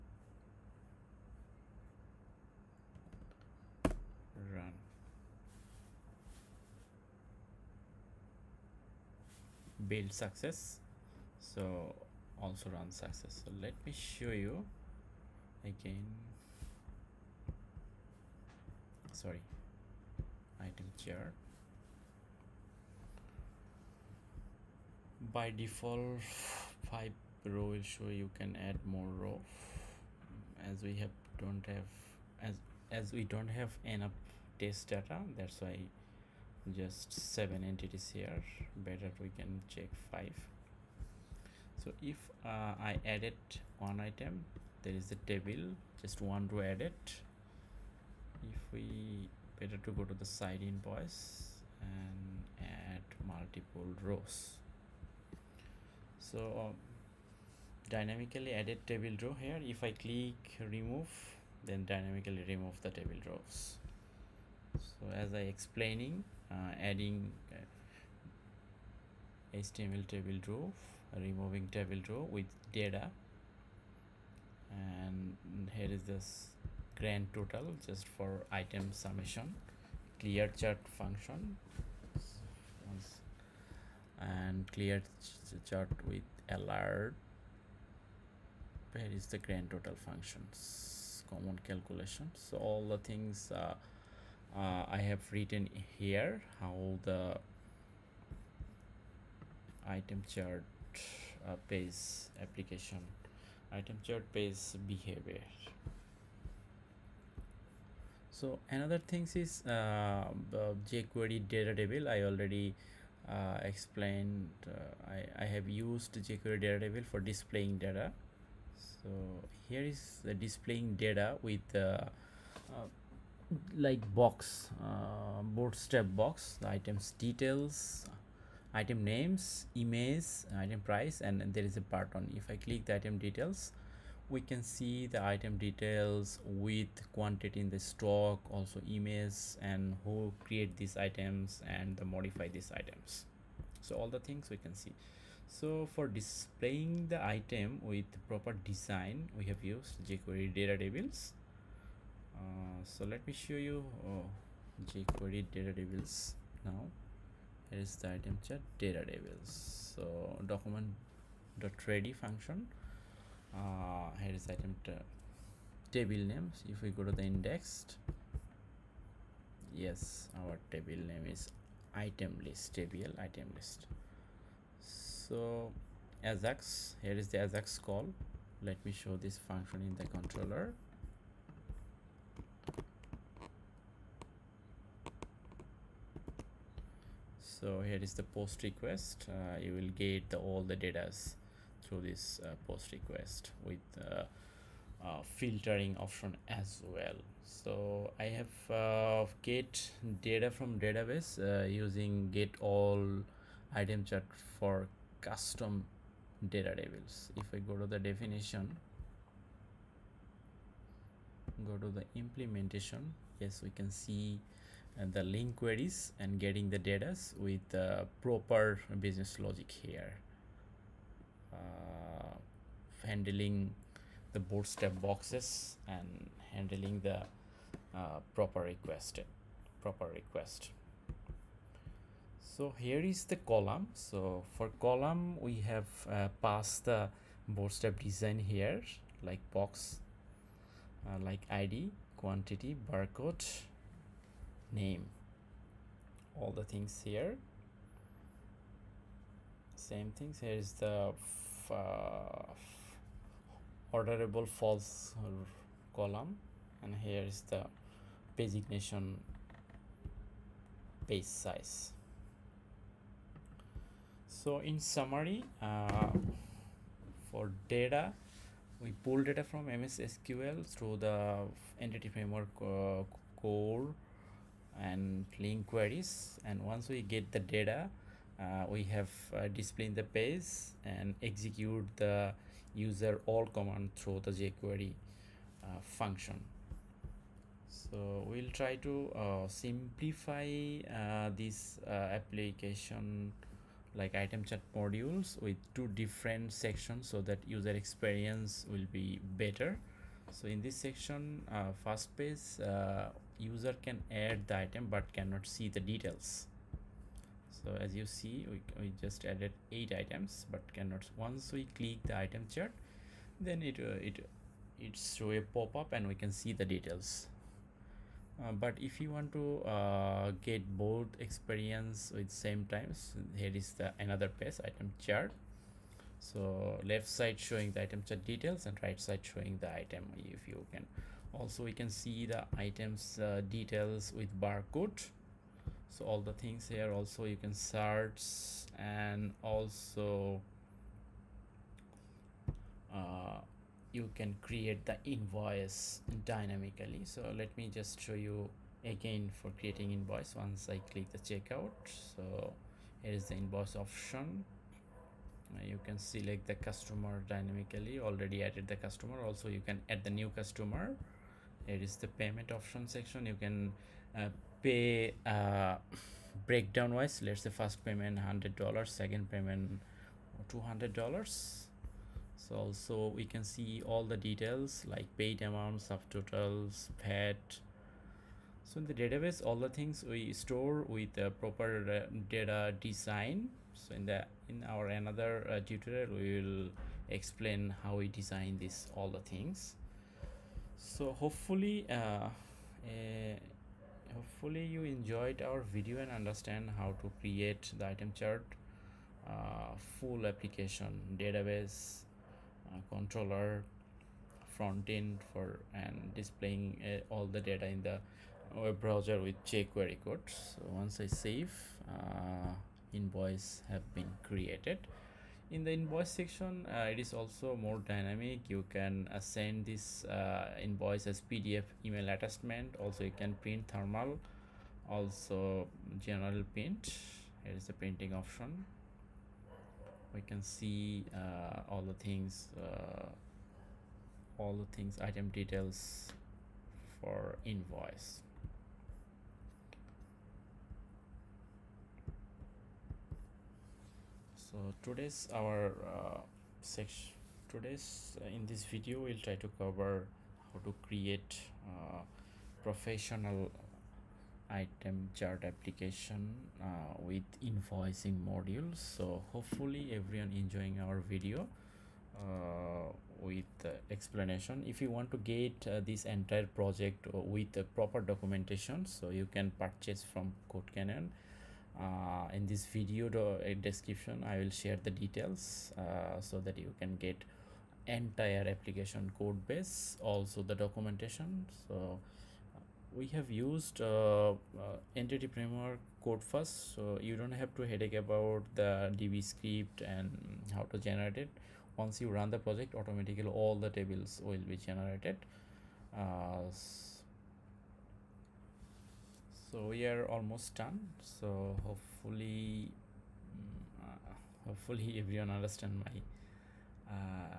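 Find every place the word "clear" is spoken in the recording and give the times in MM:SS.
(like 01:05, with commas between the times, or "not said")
01:20, 01:24.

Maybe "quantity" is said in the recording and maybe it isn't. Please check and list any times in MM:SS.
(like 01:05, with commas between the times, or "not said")
02:17, 04:02.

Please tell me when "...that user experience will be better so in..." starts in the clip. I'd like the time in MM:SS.
04:57.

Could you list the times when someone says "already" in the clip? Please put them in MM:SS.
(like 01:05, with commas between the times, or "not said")
01:52, 05:58.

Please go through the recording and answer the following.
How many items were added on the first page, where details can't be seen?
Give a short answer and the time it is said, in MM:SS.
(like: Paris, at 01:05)
8, at 05:09.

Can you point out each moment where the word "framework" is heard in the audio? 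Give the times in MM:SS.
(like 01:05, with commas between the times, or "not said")
04:32, 08:05.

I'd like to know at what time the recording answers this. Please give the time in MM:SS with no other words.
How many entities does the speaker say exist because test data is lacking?
00:37.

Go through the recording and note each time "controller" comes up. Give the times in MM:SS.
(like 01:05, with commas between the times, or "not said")
03:00, 06:42.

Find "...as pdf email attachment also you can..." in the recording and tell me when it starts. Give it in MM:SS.
07:01.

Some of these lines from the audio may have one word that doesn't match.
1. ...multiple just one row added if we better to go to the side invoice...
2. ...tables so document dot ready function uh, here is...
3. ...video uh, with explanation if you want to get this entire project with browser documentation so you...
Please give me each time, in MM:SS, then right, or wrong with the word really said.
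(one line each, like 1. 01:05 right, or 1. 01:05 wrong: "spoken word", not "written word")
1. 00:45 wrong: "table", not "multiple"
2. 02:39 right
3. 07:40 wrong: "proper", not "browser".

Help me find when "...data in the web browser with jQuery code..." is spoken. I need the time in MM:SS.
06:47.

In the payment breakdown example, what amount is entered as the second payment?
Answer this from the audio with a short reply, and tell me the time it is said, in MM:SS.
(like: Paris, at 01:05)
$200, at 06:10.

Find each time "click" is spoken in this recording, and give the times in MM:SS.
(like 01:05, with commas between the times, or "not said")
00:59, 02:12, 05:11, 05:50.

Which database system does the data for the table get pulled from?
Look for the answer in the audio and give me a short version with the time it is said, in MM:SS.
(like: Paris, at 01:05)
MS SQL, at 04:29.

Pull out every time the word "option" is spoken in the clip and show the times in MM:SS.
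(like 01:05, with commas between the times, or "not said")
03:15, 05:53, 06:02, 07:08.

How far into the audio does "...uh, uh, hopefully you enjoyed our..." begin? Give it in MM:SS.
06:31.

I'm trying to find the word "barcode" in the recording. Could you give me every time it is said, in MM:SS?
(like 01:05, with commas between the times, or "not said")
04:02, 05:34.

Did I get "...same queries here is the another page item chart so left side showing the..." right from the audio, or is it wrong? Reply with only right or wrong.
wrong.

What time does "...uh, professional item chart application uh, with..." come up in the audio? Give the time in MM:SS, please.
07:31.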